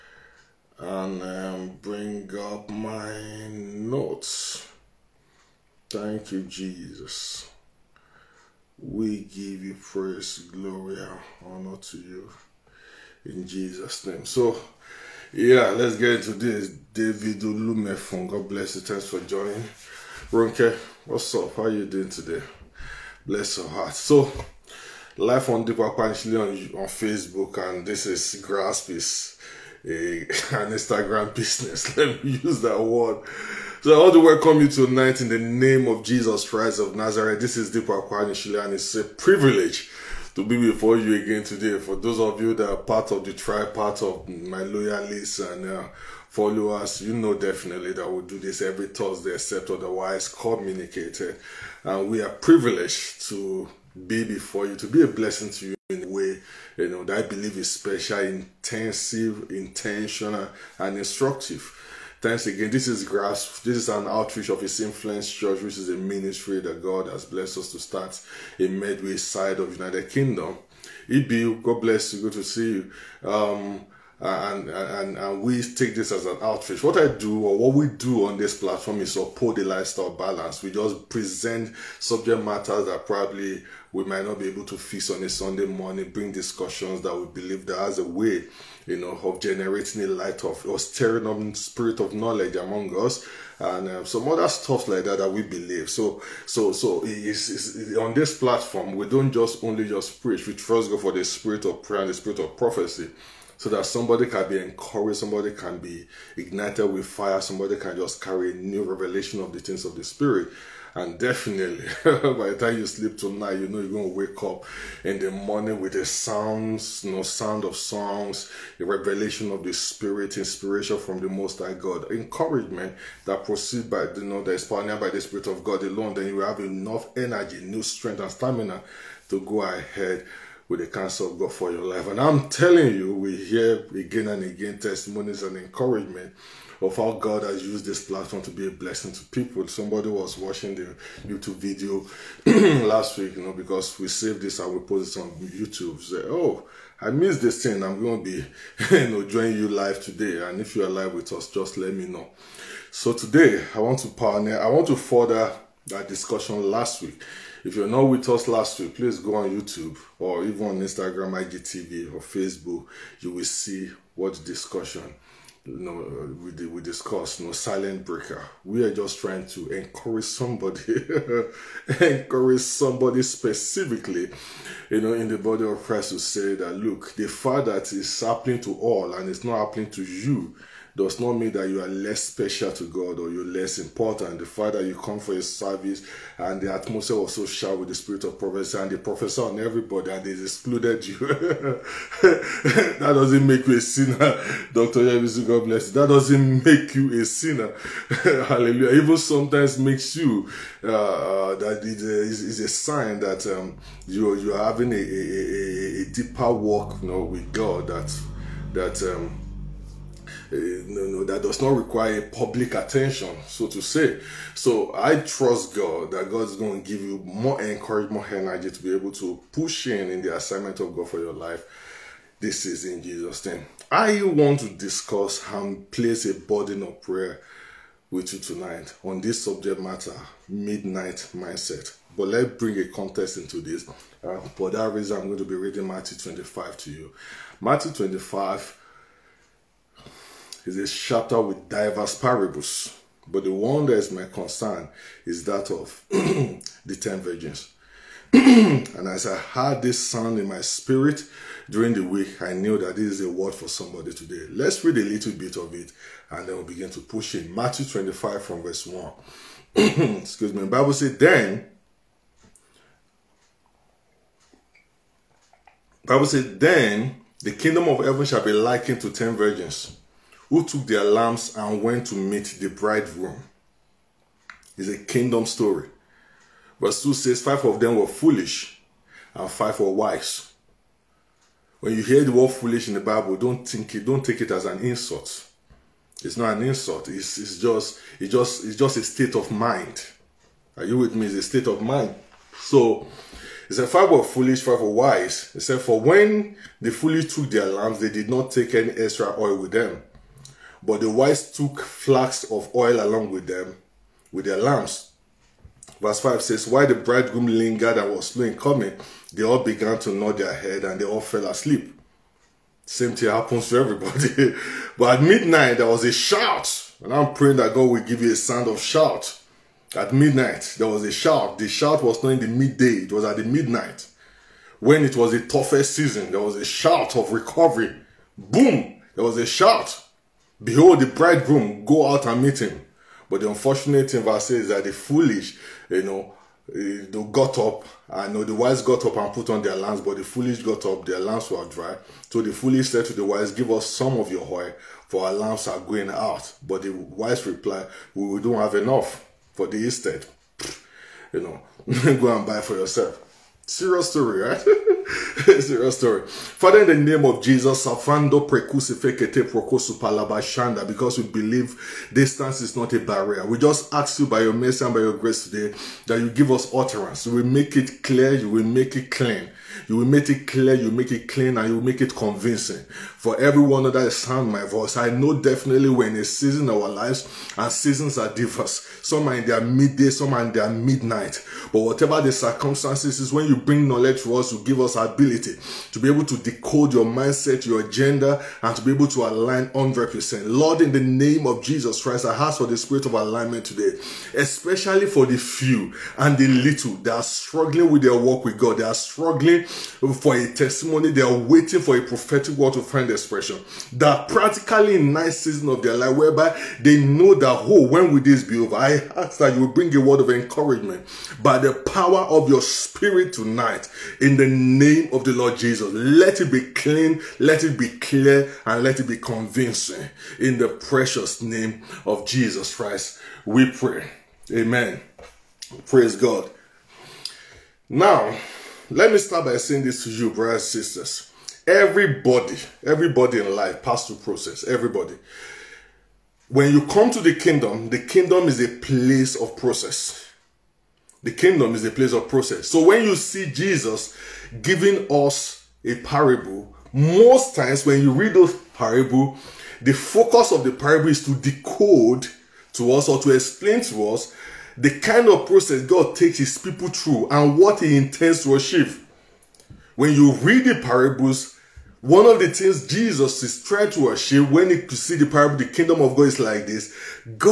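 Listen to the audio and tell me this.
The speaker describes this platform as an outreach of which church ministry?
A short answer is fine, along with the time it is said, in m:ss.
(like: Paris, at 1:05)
His Influence Church, at 1:04.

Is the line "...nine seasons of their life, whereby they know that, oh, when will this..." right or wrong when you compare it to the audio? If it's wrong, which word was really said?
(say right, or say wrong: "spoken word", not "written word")
right.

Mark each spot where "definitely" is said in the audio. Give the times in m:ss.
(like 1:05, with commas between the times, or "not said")
0:47, 1:51, 6:15.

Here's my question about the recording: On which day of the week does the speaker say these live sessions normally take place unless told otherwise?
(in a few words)
Thursday.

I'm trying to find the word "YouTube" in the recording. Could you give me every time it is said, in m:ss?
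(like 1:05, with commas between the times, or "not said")
2:21, 2:25, 2:39.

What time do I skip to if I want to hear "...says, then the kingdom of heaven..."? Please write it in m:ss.
4:26.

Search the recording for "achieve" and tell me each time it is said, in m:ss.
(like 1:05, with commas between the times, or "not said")
7:38, 7:44.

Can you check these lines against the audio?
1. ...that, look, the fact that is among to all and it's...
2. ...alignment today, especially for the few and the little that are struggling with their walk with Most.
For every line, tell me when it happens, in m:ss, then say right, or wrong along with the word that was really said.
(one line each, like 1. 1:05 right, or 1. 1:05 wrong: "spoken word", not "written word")
1. 2:56 wrong: "happening", not "among"
2. 6:33 wrong: "God", not "Most".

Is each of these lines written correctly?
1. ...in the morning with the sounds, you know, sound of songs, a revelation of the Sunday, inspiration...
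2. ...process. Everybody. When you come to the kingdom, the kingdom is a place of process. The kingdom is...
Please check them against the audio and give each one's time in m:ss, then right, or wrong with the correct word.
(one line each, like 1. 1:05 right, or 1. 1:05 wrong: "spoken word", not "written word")
1. 1:55 wrong: "Spirit", not "Sunday"
2. 7:14 right.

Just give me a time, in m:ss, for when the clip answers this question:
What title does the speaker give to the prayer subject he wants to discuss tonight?
3:50.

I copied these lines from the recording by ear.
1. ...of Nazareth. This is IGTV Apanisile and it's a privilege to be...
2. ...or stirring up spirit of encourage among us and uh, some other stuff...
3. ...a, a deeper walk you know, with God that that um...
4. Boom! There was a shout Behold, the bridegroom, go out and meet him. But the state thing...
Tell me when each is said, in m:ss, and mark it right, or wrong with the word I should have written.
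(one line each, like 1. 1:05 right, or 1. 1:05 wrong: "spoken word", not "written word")
1. 0:36 wrong: "Dipo", not "IGTV"
2. 1:30 wrong: "knowledge", not "encourage"
3. 3:24 right
4. 5:28 wrong: "unfortunate", not "state".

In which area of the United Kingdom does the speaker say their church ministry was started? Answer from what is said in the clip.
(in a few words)
Medway.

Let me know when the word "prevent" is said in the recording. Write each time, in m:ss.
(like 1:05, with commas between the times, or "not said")
not said.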